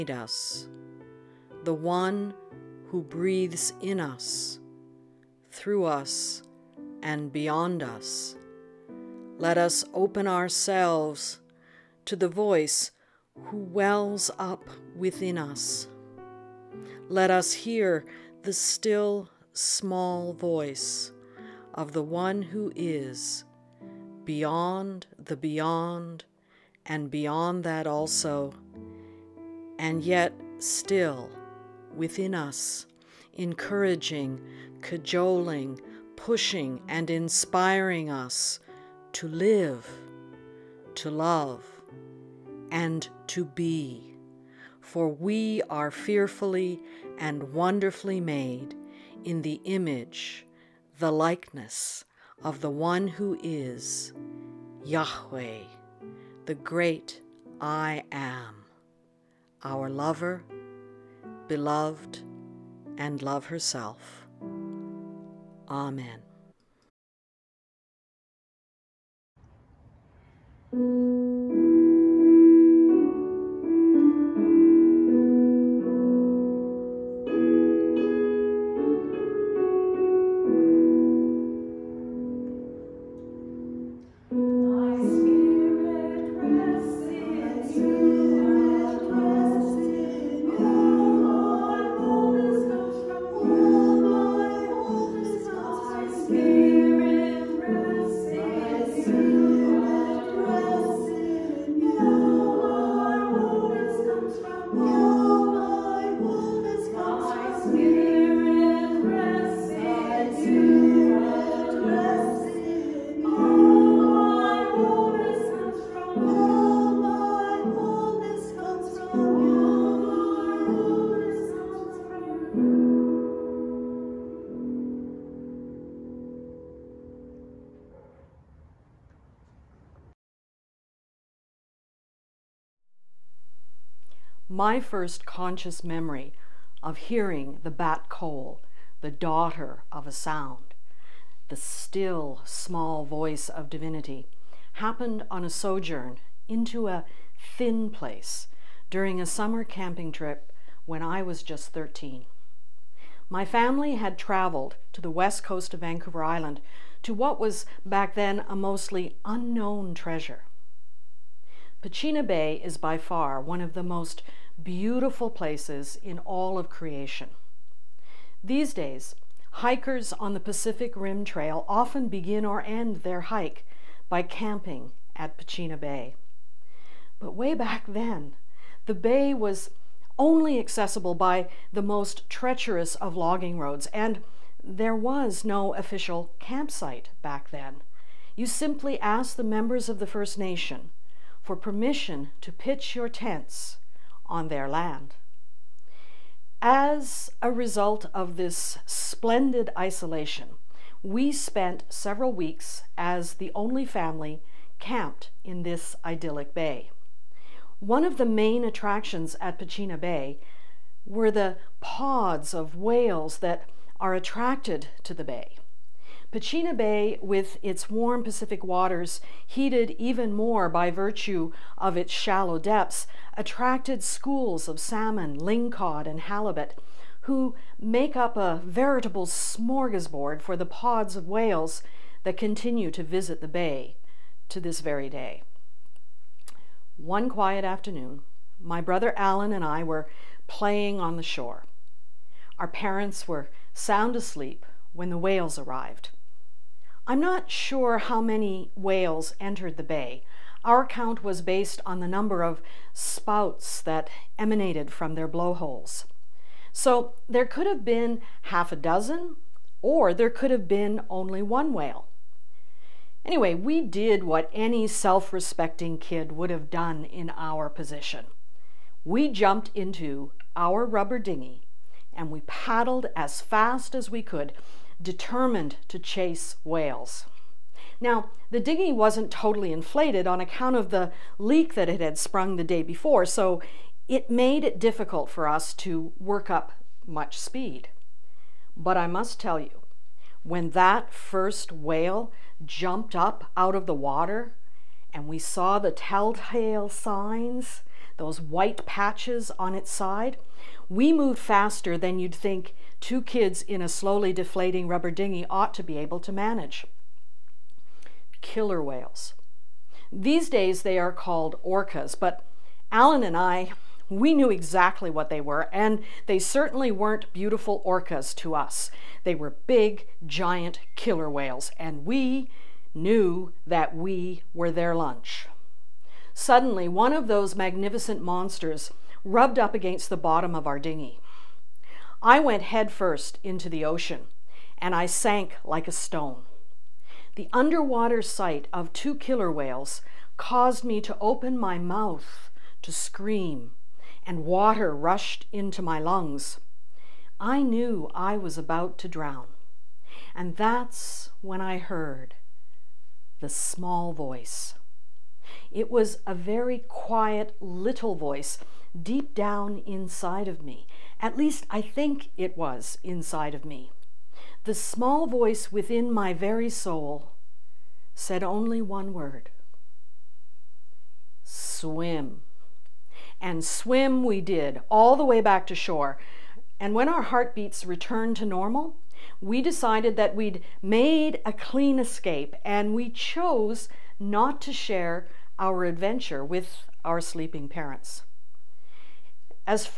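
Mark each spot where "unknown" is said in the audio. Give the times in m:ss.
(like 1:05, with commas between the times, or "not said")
2:39.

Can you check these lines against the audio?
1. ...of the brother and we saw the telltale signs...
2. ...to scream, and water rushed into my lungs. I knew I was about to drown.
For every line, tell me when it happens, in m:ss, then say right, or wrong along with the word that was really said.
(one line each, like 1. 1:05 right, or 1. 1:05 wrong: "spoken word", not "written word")
1. 4:53 wrong: "water", not "brother"
2. 5:42 right.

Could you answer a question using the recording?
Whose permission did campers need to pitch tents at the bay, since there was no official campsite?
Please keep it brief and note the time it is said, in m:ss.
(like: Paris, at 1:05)
the First Nation, at 3:09.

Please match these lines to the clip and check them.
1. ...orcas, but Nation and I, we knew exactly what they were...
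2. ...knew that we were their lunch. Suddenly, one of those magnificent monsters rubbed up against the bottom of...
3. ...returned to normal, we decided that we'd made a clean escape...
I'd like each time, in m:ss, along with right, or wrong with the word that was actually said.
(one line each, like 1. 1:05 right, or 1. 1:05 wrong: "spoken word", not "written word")
1. 5:11 wrong: "Alan", not "Nation"
2. 5:22 right
3. 6:17 right.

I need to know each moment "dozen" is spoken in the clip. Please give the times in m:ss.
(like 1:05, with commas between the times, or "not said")
4:18.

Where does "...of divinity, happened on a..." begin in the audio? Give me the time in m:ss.
2:23.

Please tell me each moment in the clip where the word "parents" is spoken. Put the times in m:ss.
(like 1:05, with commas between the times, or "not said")
4:02, 6:27.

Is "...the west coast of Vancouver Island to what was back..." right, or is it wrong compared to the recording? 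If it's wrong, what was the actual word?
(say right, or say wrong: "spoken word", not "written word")
right.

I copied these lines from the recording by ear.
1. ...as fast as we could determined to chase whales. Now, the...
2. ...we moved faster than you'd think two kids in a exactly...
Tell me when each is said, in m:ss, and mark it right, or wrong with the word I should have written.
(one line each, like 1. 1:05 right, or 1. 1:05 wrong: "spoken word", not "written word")
1. 4:33 right
2. 5:00 wrong: "slowly", not "exactly".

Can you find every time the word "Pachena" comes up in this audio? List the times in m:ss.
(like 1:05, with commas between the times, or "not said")
2:41, 2:55, 3:29, 3:36.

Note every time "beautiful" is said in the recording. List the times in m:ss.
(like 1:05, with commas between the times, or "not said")
2:44, 5:17.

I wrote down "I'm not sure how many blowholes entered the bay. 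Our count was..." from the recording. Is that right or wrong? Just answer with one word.
wrong.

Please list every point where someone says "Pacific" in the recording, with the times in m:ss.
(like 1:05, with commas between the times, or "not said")
2:50, 3:38.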